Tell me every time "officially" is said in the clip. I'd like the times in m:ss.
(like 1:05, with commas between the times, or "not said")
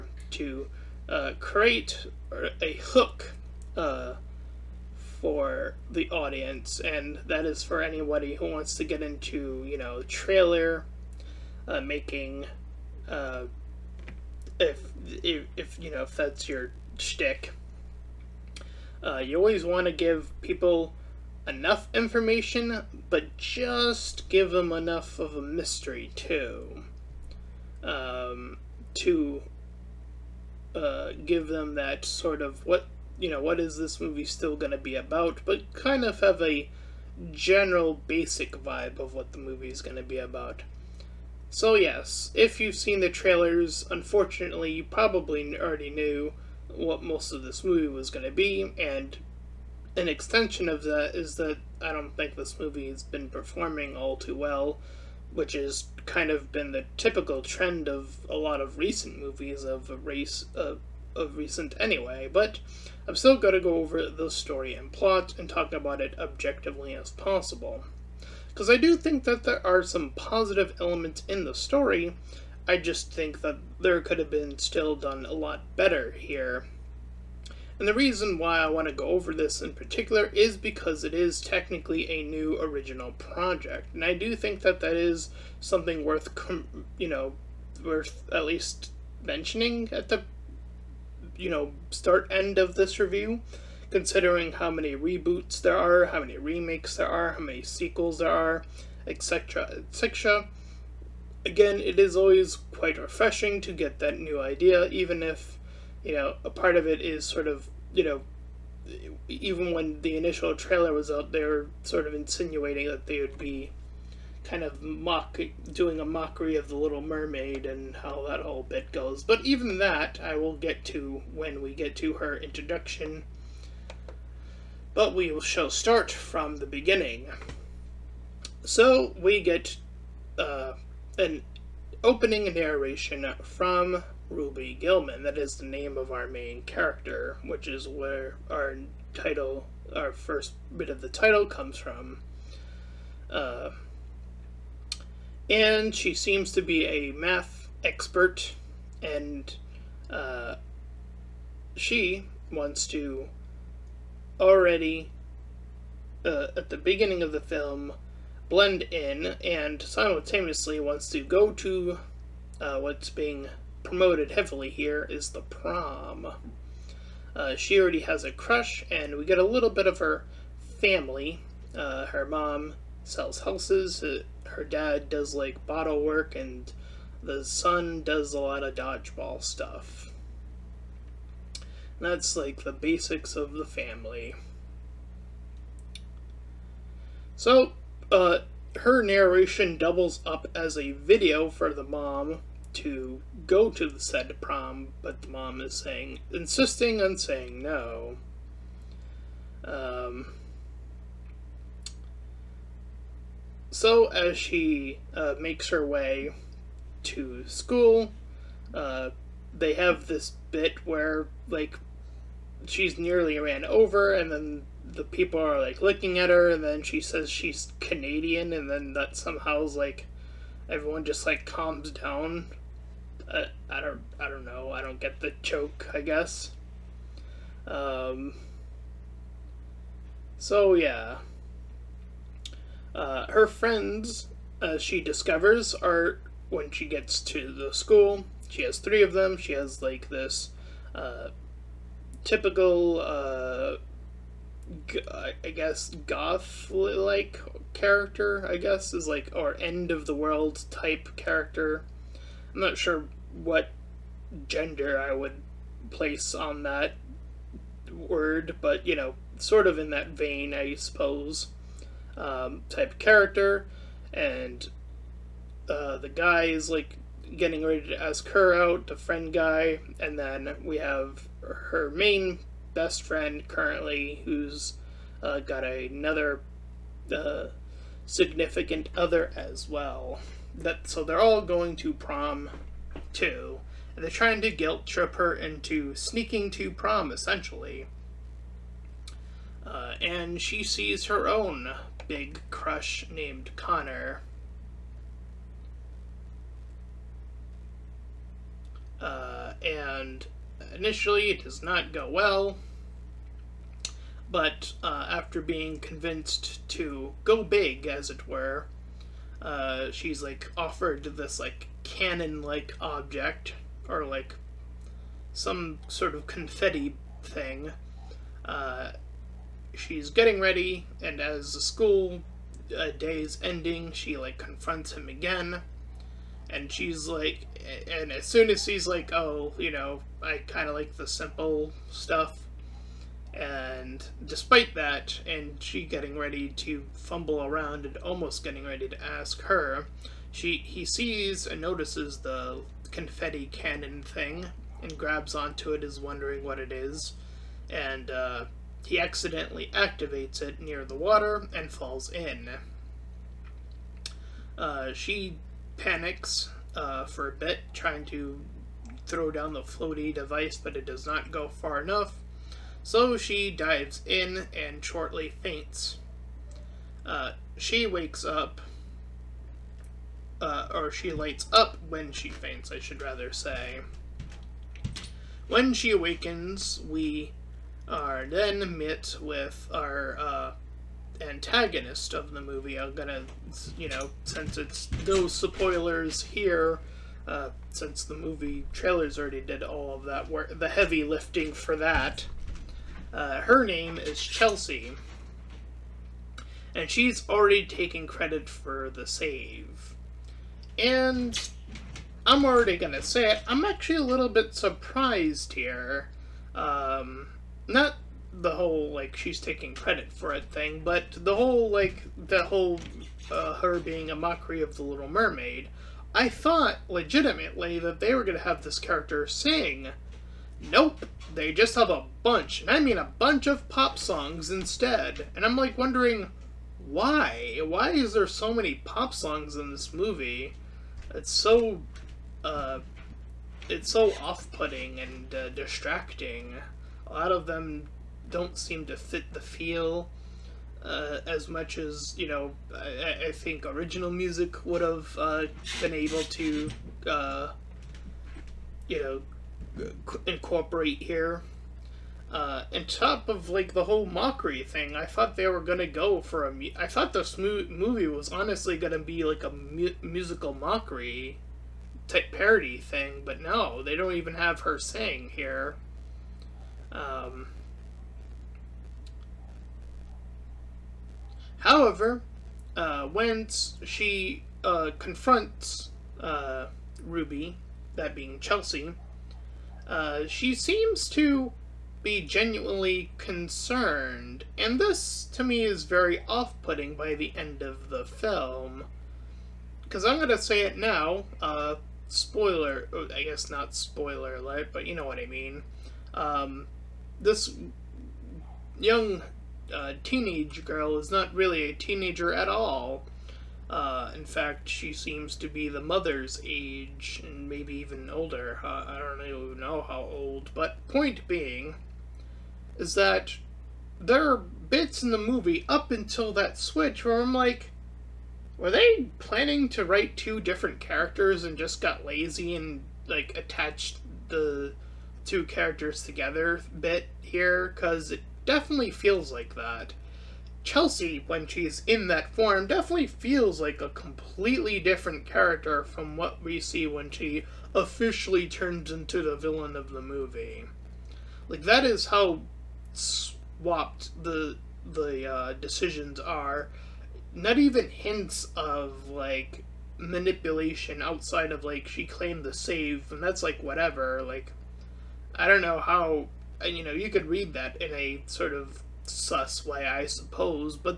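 8:57.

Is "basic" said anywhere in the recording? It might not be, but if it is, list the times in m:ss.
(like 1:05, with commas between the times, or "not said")
0:38, 3:02.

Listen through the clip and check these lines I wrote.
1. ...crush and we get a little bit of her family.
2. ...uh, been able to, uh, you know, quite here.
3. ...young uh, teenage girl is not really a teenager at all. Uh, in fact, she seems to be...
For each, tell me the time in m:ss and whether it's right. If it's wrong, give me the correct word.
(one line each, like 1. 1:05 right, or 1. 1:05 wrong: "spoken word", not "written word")
1. 2:48 right
2. 7:25 wrong: "incorporate", not "quite"
3. 8:18 right.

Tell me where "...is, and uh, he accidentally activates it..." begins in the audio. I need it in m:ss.
5:46.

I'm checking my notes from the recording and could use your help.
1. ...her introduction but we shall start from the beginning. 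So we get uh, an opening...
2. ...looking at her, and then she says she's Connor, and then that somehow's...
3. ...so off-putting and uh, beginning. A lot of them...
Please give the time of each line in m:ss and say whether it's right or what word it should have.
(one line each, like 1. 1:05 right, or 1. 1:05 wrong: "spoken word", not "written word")
1. 2:02 right
2. 3:35 wrong: "Canadian", not "Connor"
3. 7:13 wrong: "distracting", not "beginning".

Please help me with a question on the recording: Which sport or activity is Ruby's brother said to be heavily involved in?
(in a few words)
Dodgeball.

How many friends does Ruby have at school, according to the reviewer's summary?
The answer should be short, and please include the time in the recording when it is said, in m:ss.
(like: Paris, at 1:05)
3, at 3:58.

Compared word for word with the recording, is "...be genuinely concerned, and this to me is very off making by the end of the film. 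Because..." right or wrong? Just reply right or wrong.
wrong.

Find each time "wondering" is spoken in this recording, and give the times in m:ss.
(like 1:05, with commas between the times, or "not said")
5:45, 7:05.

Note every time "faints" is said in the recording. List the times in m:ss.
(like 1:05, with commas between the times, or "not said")
6:05, 6:12.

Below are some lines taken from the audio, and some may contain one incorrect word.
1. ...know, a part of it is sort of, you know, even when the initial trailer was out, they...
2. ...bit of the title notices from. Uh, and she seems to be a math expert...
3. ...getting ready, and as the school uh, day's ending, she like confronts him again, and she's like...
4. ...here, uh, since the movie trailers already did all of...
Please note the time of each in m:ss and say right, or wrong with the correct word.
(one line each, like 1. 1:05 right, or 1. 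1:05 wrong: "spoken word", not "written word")
1. 1:46 right
2. 2:20 wrong: "comes", not "notices"
3. 5:20 right
4. 6:26 right.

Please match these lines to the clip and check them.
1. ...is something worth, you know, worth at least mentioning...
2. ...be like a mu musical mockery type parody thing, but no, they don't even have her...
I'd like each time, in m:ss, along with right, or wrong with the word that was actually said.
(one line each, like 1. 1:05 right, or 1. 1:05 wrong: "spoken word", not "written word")
1. 1:24 right
2. 7:38 right.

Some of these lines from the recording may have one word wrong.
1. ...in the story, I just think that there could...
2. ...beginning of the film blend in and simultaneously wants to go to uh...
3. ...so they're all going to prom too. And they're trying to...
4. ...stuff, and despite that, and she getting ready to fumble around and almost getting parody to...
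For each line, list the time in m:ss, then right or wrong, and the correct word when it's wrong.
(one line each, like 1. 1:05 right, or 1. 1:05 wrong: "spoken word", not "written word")
1. 1:11 right
2. 2:36 right
3. 4:40 right
4. 5:31 wrong: "ready", not "parody".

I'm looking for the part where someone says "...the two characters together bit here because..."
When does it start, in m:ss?
8:44.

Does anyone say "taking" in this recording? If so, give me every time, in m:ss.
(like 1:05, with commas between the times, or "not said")
6:37, 6:49.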